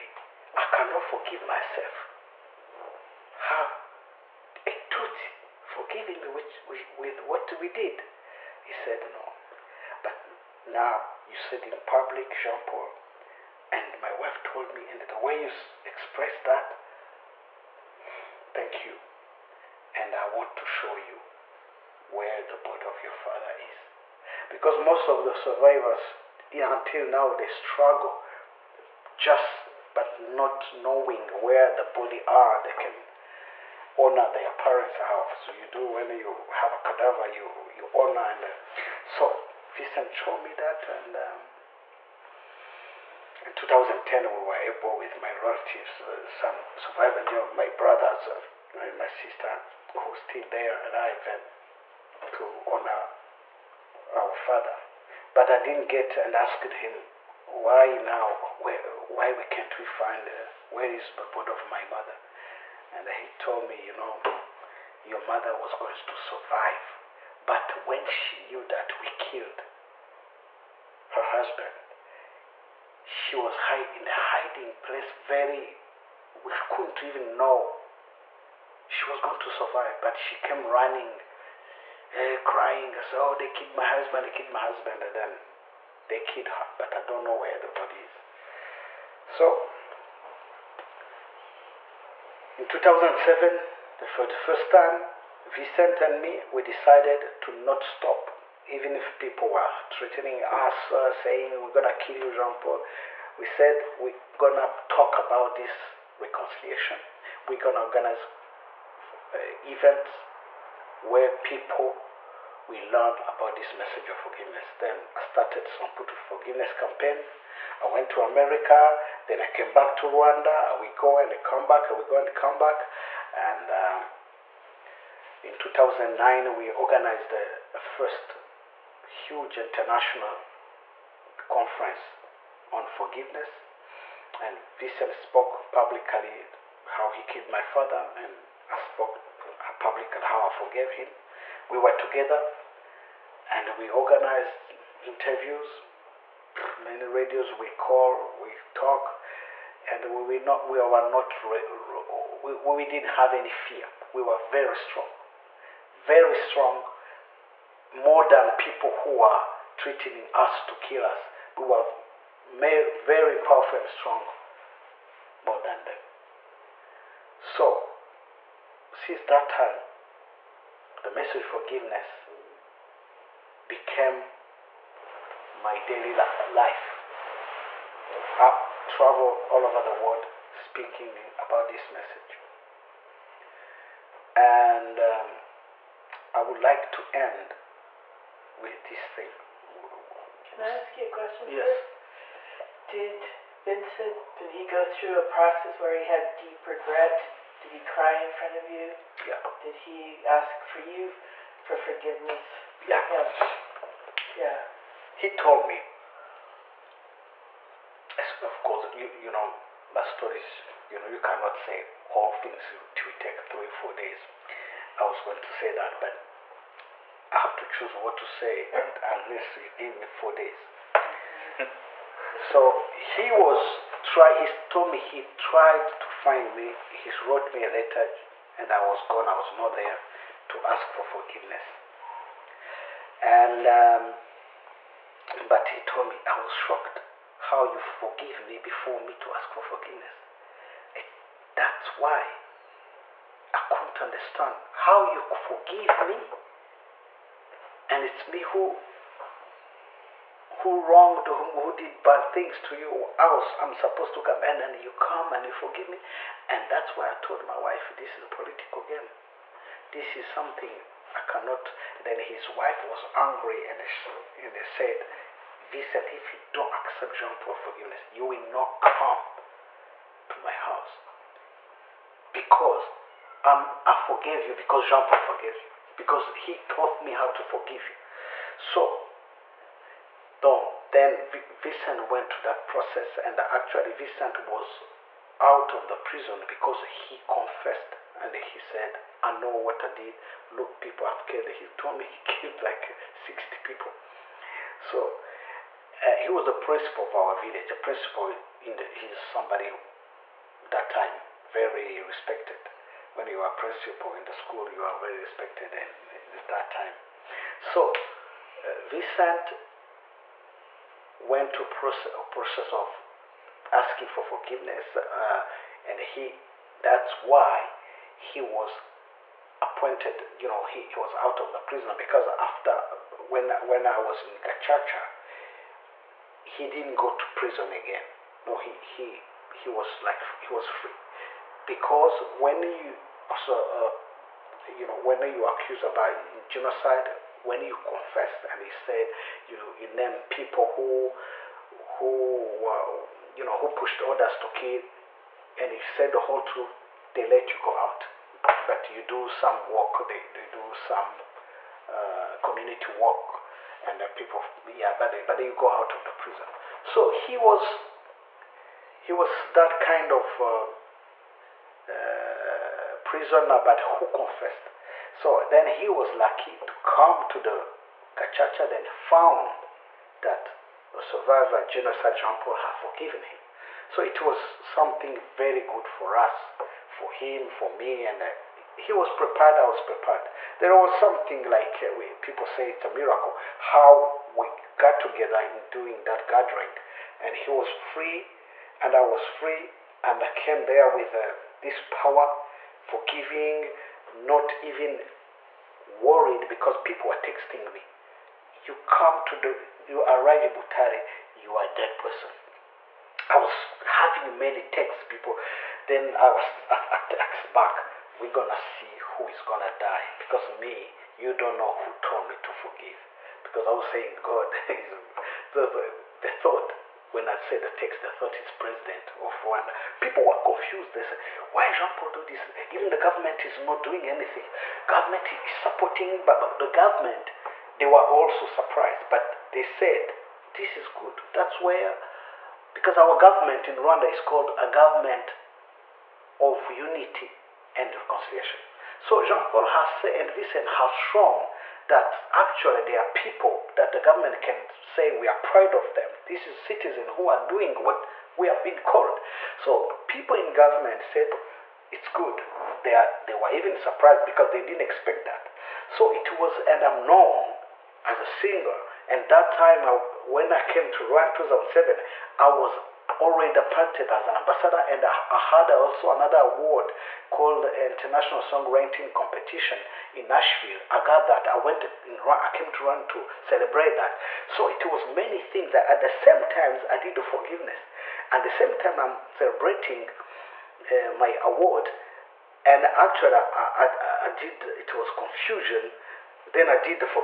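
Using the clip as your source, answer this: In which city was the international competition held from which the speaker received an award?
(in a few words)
Nashville.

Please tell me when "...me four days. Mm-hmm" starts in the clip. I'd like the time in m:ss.
3:39.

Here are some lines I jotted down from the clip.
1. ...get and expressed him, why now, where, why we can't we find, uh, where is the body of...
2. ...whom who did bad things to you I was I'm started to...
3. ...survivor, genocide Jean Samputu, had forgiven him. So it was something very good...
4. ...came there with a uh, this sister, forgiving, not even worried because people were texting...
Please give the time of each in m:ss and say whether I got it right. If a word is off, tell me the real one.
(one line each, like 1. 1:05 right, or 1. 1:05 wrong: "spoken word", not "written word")
1. 0:55 wrong: "asked", not "expressed"
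2. 4:11 wrong: "supposed", not "started"
3. 6:11 wrong: "Paul", not "Samputu"
4. 6:30 wrong: "power", not "sister".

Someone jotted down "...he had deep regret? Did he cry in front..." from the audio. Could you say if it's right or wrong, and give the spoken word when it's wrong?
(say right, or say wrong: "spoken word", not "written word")
right.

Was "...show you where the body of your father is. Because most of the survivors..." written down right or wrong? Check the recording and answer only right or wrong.
right.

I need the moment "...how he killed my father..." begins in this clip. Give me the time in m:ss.
2:16.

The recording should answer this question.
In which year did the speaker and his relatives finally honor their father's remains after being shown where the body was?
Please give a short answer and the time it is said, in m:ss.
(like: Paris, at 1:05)
2010, at 0:43.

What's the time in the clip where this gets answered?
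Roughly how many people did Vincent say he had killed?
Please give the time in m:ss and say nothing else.
4:53.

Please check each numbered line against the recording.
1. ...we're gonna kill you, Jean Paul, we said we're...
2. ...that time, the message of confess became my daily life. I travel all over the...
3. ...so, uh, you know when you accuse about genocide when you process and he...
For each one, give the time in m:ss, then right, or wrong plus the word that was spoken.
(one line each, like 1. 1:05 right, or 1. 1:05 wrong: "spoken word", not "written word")
1. 1:41 right
2. 2:49 wrong: "forgiveness", not "confess"
3. 5:33 wrong: "confess", not "process".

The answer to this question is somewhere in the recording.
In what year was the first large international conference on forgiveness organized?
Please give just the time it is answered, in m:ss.
2:05.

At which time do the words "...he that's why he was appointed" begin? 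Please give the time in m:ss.
5:15.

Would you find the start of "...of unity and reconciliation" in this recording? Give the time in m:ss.
7:16.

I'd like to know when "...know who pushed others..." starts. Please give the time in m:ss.
5:43.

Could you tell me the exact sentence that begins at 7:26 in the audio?
This is citizens who are doing what we have been called.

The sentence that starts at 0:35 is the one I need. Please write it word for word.
So you do when you have a cadaver, you, you honor.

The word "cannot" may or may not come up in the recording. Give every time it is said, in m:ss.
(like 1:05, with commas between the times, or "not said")
0:00, 3:31, 4:21.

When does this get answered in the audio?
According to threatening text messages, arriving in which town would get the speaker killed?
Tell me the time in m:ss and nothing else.
6:40.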